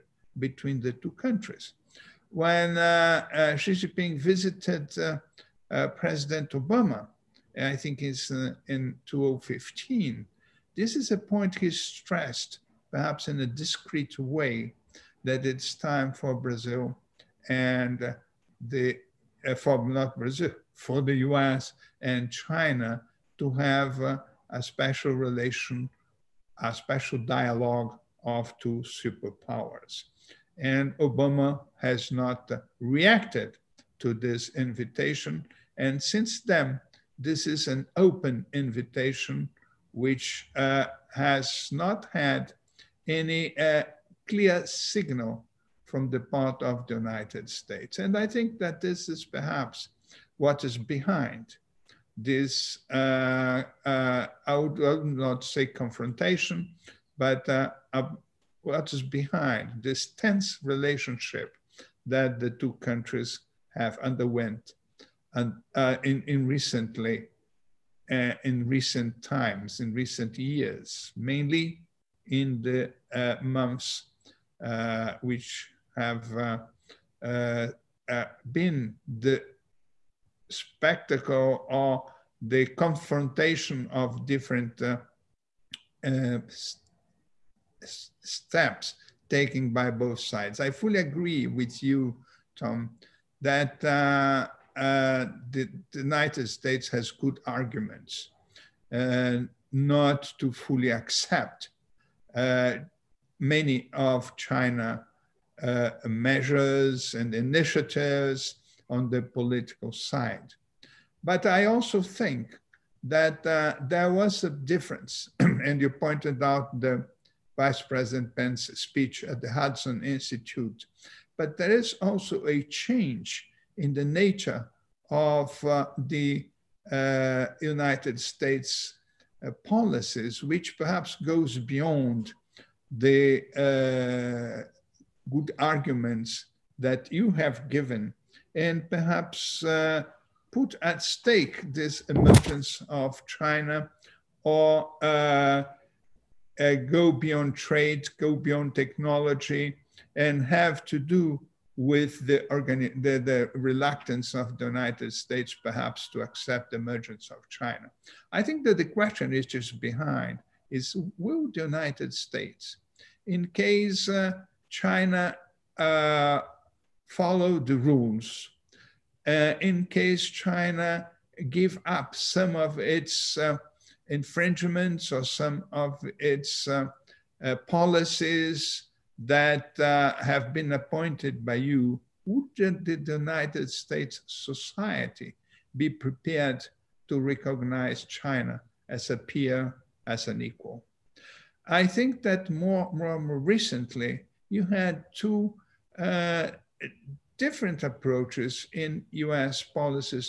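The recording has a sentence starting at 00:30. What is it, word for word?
And Obama has not reacted to this invitation.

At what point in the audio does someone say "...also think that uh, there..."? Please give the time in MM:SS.
01:51.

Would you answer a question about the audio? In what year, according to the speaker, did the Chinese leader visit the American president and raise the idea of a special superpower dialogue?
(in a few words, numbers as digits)
2015.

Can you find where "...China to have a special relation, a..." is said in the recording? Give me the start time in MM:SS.
00:22.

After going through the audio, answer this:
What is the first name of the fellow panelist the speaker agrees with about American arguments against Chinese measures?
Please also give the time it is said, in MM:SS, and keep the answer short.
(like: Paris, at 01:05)
Tom, at 01:32.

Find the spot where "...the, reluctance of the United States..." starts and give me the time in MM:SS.
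02:33.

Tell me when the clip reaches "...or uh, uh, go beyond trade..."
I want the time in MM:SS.
02:24.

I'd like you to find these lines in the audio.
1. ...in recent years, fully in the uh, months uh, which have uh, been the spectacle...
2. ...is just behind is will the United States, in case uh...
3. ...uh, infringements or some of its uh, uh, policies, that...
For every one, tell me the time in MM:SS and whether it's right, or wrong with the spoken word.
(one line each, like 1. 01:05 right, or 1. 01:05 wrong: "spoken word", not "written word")
1. 01:09 wrong: "mainly", not "fully"
2. 02:39 right
3. 02:53 right.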